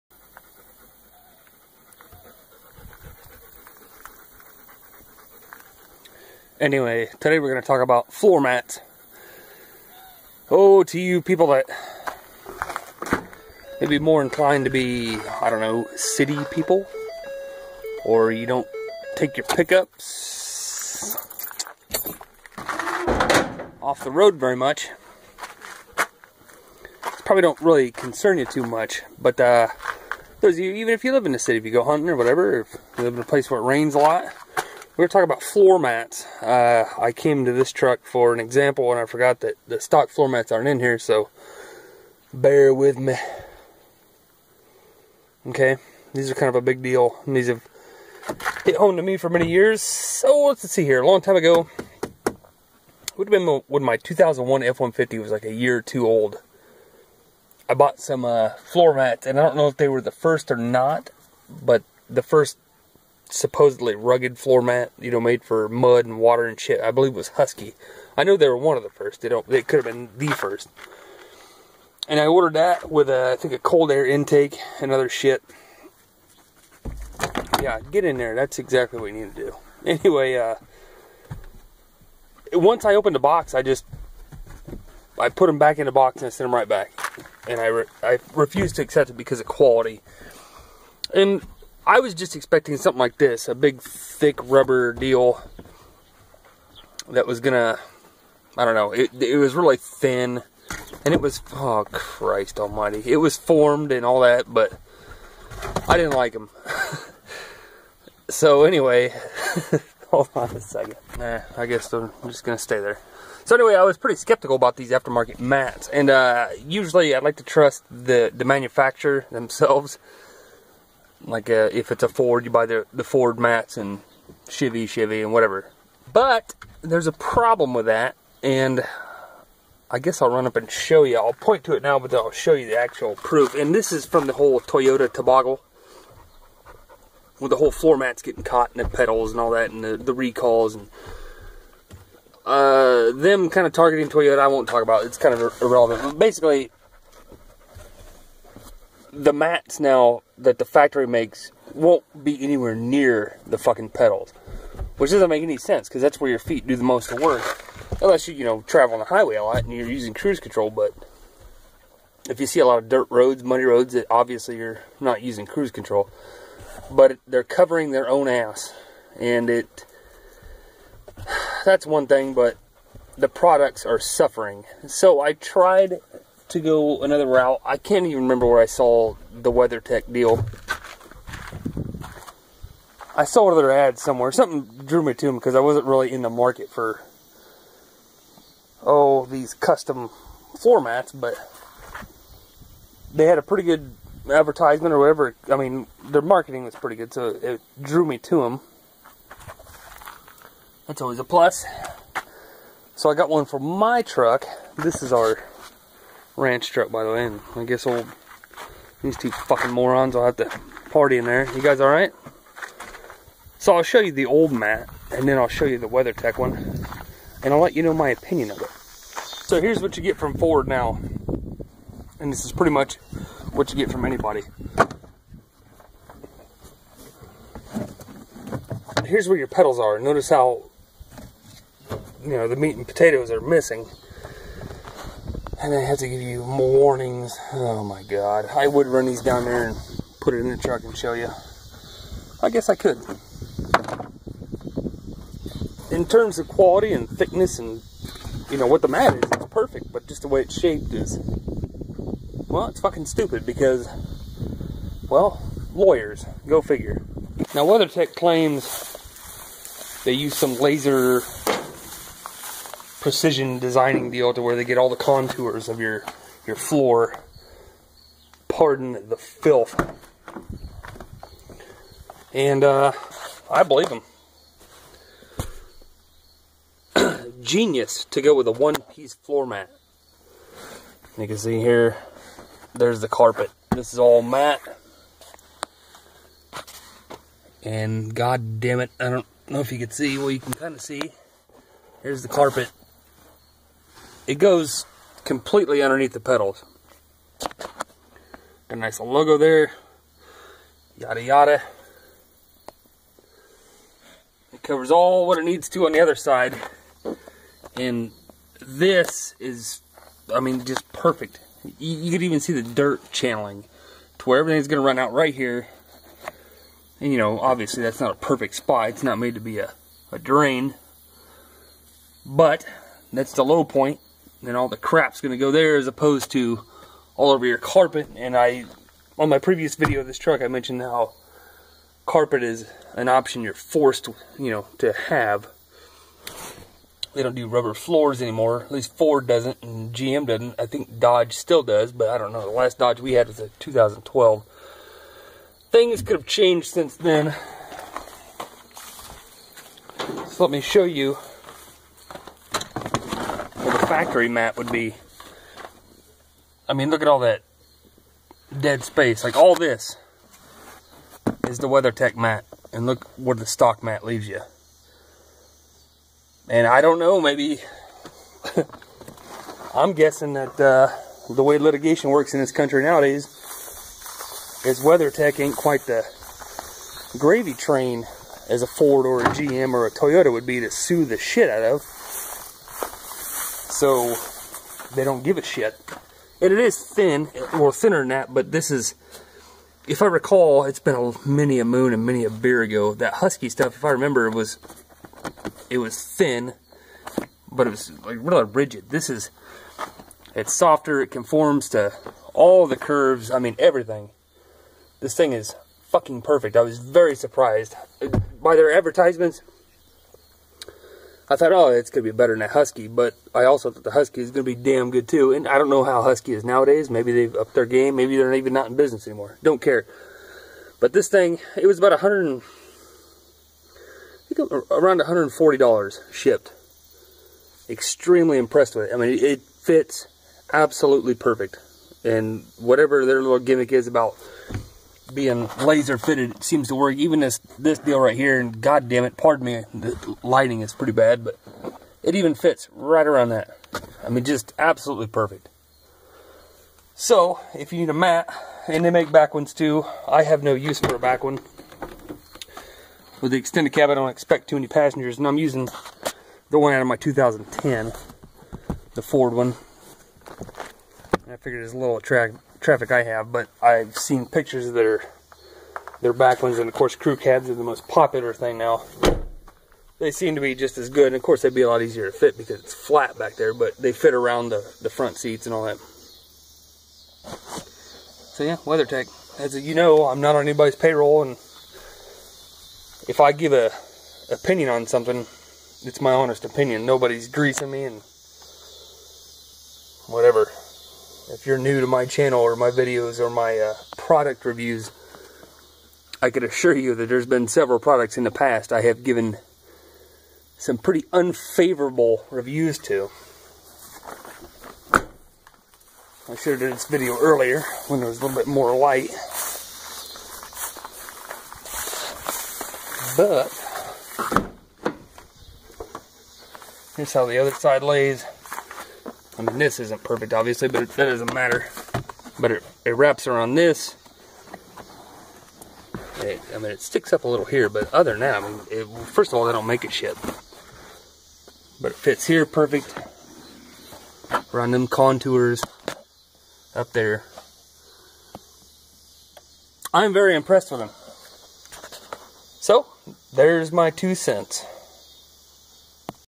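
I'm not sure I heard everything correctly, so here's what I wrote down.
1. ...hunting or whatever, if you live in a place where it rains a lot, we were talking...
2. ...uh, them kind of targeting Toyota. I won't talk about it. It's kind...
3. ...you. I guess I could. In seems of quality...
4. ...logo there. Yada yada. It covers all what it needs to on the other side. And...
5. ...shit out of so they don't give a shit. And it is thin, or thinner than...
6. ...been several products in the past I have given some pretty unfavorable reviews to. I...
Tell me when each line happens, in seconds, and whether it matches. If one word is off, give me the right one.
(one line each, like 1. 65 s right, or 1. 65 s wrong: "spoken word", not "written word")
1. 31 s right
2. 142 s right
3. 241 s wrong: "terms", not "seems"
4. 299 s right
5. 381 s right
6. 497 s right.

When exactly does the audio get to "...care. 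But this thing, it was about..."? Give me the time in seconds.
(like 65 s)
419 s.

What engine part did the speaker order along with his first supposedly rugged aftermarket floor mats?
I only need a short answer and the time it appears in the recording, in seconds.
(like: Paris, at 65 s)
cold air intake, at 73 s.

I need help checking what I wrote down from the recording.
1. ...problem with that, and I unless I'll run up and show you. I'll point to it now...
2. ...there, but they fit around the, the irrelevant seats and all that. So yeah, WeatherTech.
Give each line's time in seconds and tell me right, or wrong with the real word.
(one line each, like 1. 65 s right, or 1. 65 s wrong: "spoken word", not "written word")
1. 127 s wrong: "guess", not "unless"
2. 473 s wrong: "front", not "irrelevant".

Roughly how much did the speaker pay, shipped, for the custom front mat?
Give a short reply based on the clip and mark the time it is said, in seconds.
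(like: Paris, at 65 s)
$140, at 424 s.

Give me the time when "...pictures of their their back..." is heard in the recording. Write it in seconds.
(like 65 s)
464 s.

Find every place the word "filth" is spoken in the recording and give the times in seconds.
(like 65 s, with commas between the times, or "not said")
269 s.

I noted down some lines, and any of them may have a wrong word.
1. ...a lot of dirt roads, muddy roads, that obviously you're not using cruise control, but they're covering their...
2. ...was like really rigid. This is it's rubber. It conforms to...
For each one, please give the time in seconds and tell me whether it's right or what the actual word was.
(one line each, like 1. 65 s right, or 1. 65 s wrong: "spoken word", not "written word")
1. 162 s right
2. 397 s wrong: "softer", not "rubber".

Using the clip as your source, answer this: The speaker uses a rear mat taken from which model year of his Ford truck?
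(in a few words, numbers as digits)
2010.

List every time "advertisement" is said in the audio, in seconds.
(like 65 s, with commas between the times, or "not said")
194 s, 408 s.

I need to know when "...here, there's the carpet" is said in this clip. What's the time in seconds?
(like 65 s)
281 s.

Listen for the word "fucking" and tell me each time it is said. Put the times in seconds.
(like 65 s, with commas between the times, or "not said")
153 s, 209 s, 252 s, 405 s.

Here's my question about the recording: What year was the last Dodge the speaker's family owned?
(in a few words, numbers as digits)
2012.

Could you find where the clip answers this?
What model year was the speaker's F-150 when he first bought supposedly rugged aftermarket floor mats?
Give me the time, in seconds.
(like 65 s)
53 s.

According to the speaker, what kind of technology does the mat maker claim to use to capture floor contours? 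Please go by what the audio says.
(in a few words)
laser precision designing.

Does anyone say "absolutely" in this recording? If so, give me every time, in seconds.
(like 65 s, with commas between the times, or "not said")
430 s, 444 s.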